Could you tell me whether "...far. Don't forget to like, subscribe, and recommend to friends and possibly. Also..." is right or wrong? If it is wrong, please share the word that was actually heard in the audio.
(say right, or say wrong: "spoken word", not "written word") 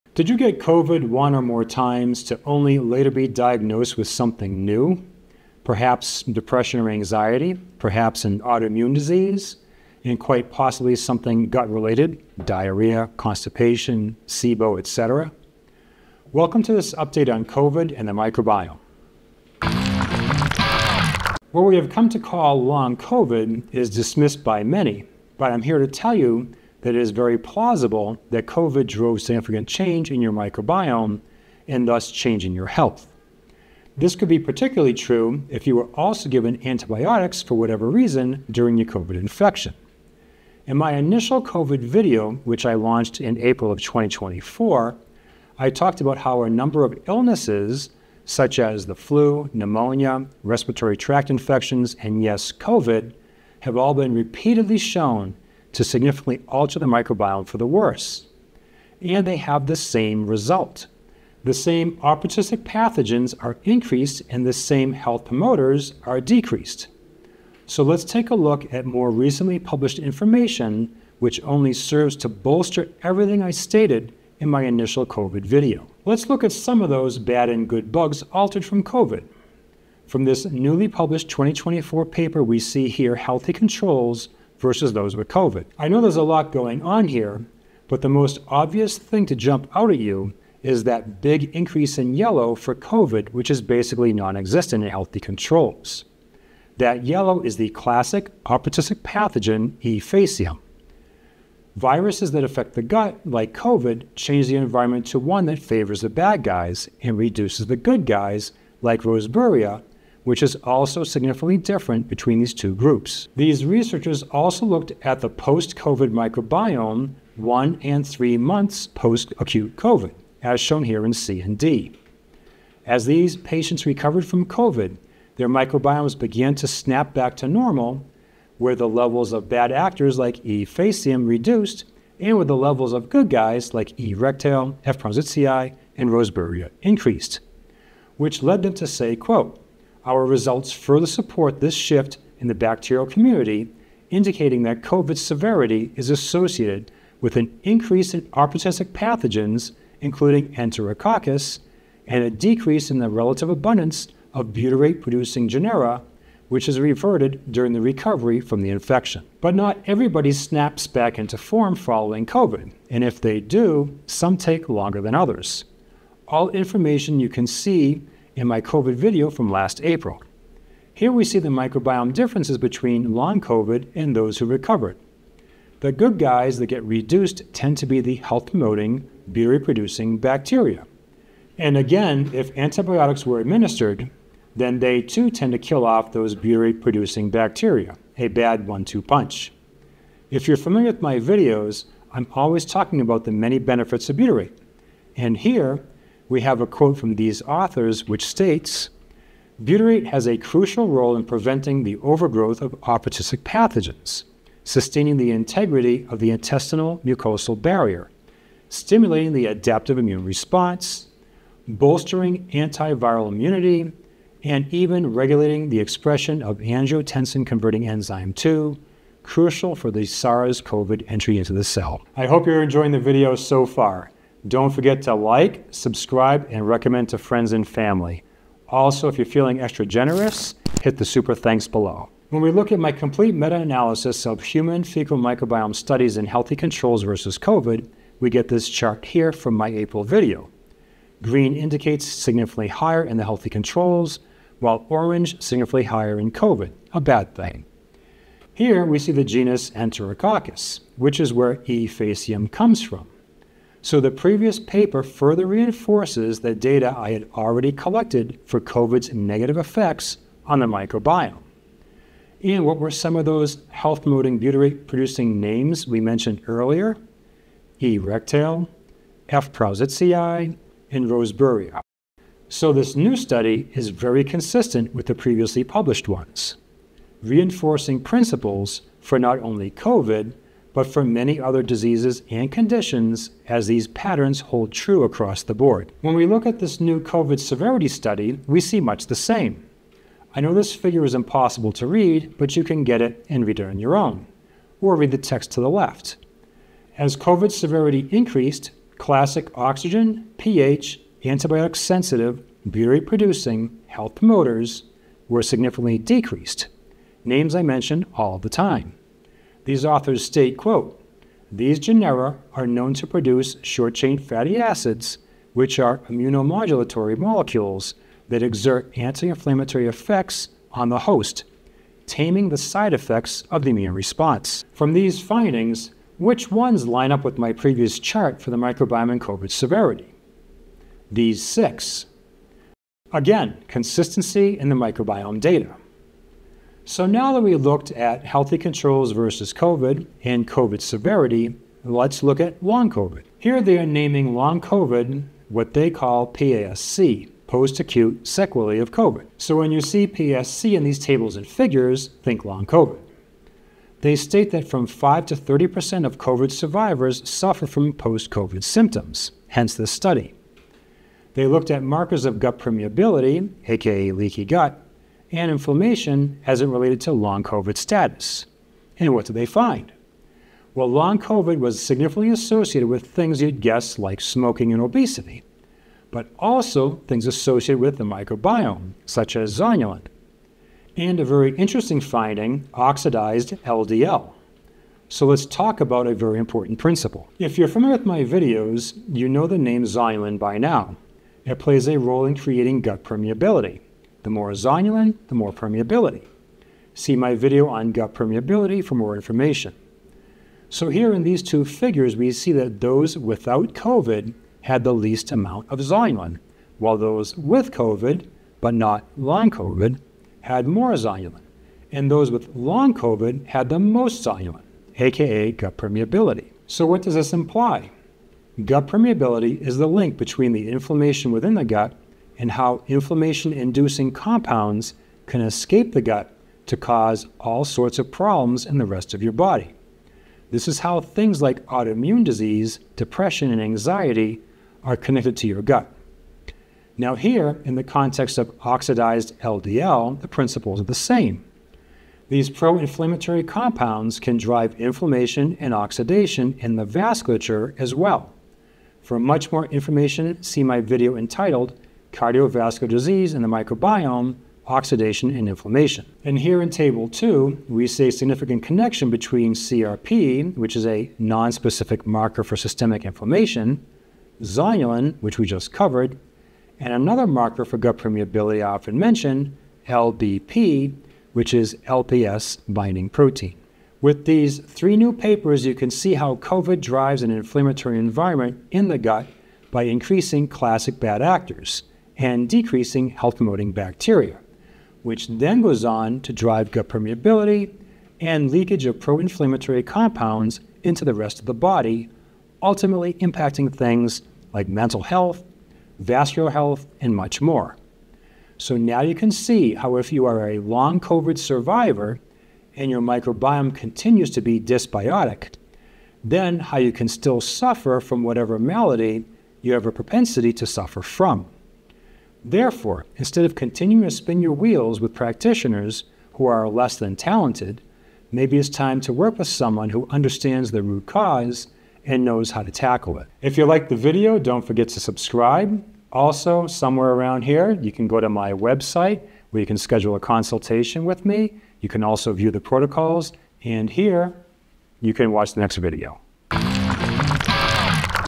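wrong: "family", not "possibly".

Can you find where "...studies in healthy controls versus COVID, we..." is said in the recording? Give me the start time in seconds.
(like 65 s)
235 s.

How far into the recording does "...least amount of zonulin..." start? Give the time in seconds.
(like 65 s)
404 s.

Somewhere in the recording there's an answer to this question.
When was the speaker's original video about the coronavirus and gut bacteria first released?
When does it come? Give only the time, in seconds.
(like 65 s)
43 s.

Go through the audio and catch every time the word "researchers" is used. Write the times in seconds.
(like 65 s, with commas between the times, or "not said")
113 s.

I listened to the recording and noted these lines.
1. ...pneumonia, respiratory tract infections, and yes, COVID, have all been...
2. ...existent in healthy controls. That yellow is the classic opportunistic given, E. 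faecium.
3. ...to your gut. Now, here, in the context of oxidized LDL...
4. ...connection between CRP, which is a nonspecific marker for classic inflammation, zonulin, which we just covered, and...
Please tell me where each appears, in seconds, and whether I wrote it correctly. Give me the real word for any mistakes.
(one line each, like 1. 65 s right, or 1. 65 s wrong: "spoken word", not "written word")
1. 49 s right
2. 94 s wrong: "pathogen", not "given"
3. 435 s right
4. 458 s wrong: "systemic", not "classic".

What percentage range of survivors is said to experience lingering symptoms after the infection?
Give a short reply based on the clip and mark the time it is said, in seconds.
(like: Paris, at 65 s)
5 to 30%, at 354 s.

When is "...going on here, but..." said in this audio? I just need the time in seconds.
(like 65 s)
86 s.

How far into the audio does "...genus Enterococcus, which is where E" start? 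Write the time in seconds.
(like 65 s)
249 s.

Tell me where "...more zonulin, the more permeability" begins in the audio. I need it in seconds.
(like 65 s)
394 s.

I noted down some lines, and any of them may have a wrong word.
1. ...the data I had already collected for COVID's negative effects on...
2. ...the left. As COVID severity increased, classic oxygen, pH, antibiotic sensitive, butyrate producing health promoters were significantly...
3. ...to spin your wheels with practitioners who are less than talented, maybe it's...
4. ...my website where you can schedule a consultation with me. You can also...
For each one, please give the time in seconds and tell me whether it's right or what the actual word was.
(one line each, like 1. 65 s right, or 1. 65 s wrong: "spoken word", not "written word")
1. 256 s right
2. 295 s right
3. 514 s right
4. 528 s right.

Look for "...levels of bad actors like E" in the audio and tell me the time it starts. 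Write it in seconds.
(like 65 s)
128 s.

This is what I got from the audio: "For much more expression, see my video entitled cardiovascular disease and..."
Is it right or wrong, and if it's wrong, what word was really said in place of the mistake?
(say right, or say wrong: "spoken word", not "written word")
wrong: "information", not "expression".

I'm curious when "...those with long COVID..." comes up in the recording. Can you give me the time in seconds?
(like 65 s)
412 s.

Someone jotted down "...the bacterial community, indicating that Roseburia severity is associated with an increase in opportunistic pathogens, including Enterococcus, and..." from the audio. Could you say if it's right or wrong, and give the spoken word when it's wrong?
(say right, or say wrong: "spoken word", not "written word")
wrong: "COVID", not "Roseburia".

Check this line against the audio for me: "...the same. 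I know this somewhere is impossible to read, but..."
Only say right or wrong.
wrong.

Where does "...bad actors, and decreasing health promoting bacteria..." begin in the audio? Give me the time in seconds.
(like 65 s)
480 s.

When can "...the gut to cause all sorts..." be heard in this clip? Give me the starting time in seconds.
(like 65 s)
425 s.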